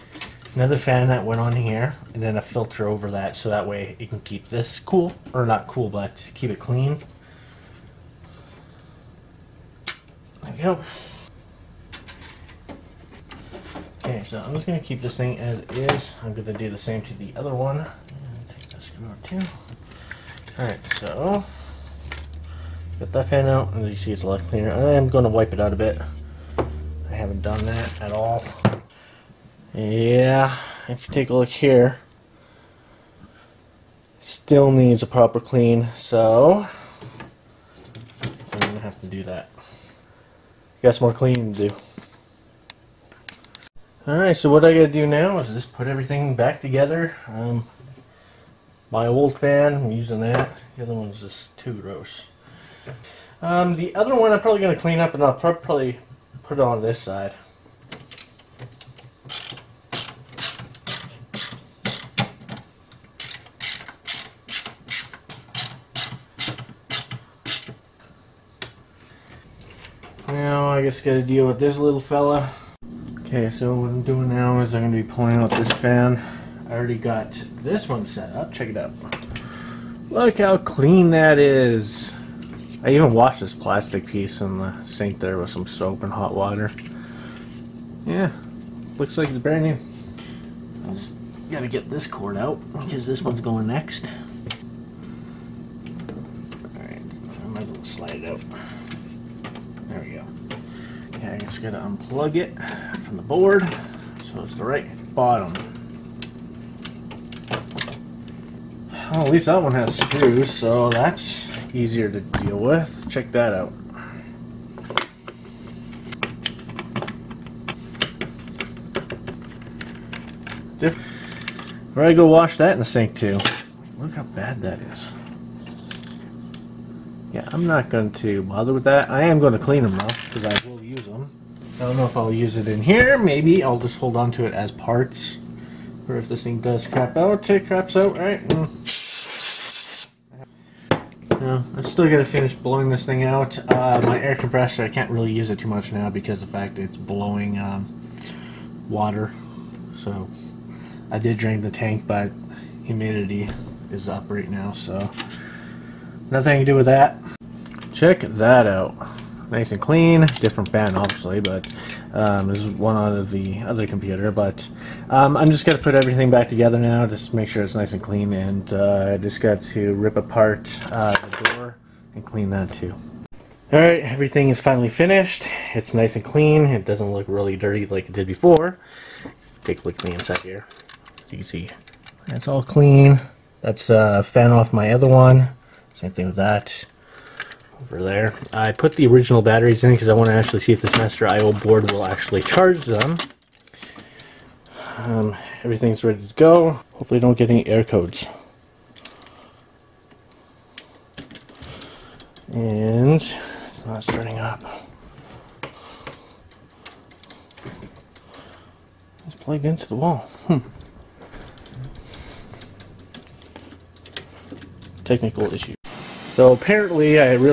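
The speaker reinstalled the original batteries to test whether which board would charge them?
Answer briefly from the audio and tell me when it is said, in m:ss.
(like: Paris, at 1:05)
master IO board, at 3:10.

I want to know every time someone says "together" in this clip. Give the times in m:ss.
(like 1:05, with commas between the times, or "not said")
0:46, 2:46.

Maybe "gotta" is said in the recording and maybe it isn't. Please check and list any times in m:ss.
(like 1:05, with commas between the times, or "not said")
0:44, 1:11, 1:31, 1:41, 2:22.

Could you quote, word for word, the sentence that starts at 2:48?
And uh, I just got to rip apart uh, the door and clean that too.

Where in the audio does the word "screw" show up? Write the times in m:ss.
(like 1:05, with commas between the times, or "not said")
0:18, 1:49.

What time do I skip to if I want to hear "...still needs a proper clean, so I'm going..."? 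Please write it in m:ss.
0:34.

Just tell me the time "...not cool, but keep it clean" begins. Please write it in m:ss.
0:05.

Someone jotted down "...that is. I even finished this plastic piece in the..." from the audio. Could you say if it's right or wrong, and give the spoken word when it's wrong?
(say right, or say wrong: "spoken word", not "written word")
wrong: "washed", not "finished".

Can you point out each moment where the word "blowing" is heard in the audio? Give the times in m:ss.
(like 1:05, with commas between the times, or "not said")
2:22, 2:26.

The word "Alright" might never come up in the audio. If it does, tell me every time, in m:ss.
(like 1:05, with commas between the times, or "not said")
0:20, 0:44, 1:36, 2:53.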